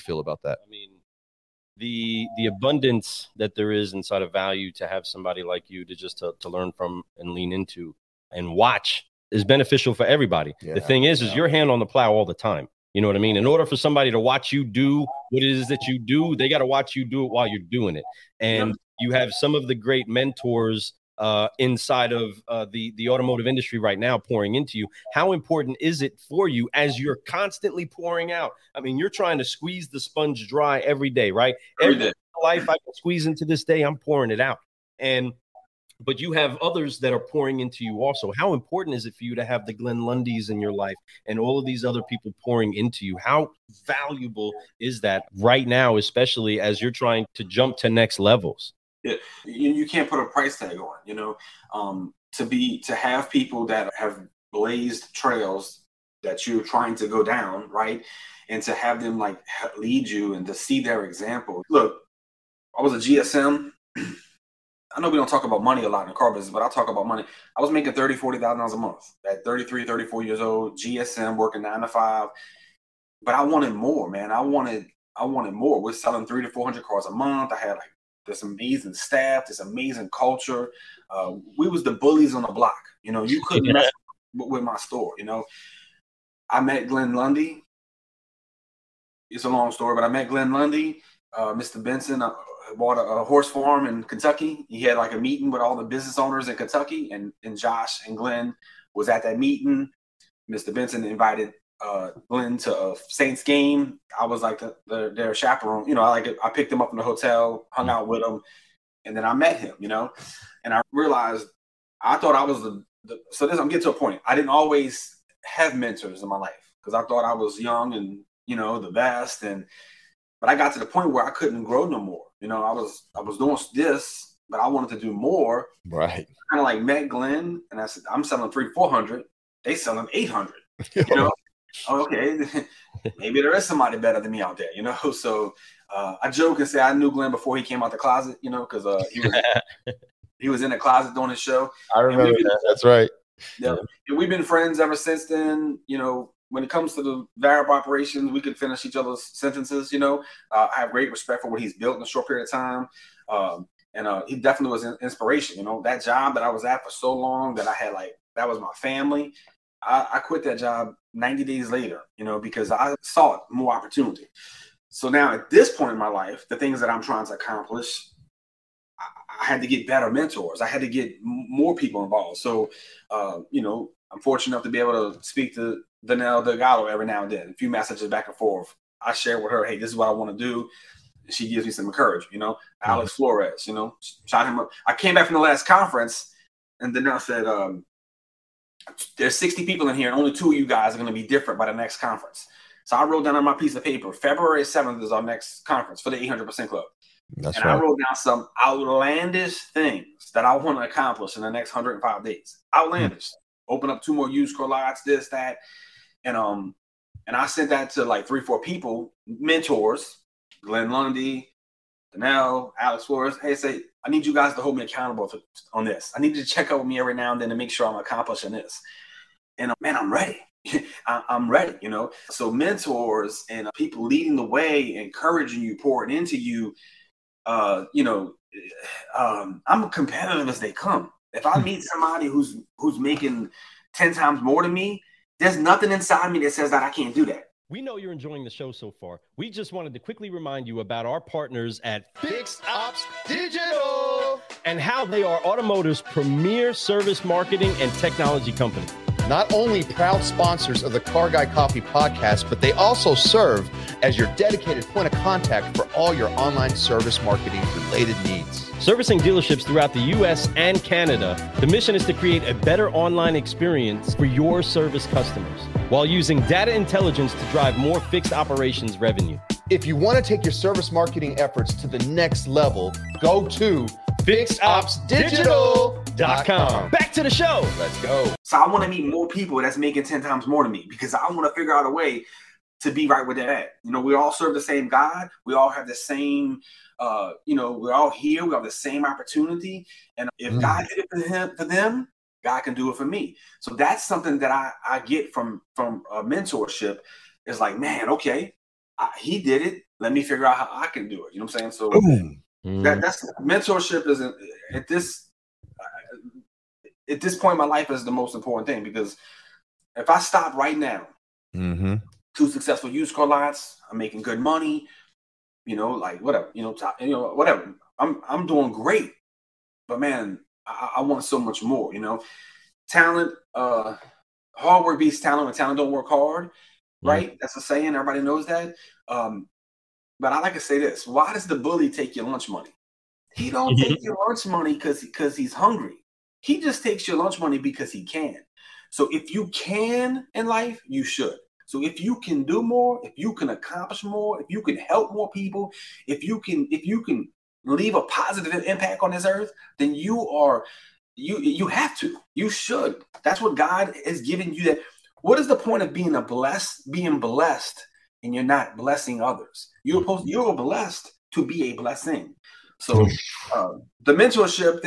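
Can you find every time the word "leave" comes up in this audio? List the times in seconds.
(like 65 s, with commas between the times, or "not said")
347 s.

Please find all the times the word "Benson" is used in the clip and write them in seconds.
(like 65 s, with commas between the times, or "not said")
91 s, 100 s.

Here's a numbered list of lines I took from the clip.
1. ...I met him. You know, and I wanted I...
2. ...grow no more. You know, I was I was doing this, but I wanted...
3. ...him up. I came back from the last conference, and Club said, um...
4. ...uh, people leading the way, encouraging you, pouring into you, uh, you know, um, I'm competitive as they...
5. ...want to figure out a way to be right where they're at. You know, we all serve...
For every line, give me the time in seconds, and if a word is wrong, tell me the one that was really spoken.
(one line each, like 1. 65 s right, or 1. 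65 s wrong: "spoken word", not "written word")
1. 109 s wrong: "realized", not "wanted"
2. 121 s right
3. 184 s wrong: "Danelle", not "Club"
4. 223 s right
5. 281 s right.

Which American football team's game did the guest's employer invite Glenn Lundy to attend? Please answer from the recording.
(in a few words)
Saints.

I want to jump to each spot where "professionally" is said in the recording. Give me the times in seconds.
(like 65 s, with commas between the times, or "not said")
not said.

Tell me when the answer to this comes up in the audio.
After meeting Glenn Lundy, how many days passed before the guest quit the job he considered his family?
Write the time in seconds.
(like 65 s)
161 s.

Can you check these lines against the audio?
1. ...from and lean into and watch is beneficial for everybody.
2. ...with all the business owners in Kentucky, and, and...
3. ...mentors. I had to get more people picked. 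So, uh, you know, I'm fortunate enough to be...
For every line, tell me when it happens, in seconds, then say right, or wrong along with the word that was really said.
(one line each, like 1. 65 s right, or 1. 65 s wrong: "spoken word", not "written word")
1. 6 s right
2. 95 s right
3. 170 s wrong: "involved", not "picked".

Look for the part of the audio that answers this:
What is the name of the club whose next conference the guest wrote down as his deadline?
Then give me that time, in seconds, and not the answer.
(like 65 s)
196 s.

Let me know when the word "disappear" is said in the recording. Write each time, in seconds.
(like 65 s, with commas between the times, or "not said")
not said.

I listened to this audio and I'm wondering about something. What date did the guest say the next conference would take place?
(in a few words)
February 7th.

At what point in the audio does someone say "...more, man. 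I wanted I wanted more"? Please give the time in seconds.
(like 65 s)
73 s.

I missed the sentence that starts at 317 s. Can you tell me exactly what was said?
I'm I'm doing great, but man, I, I want so much more.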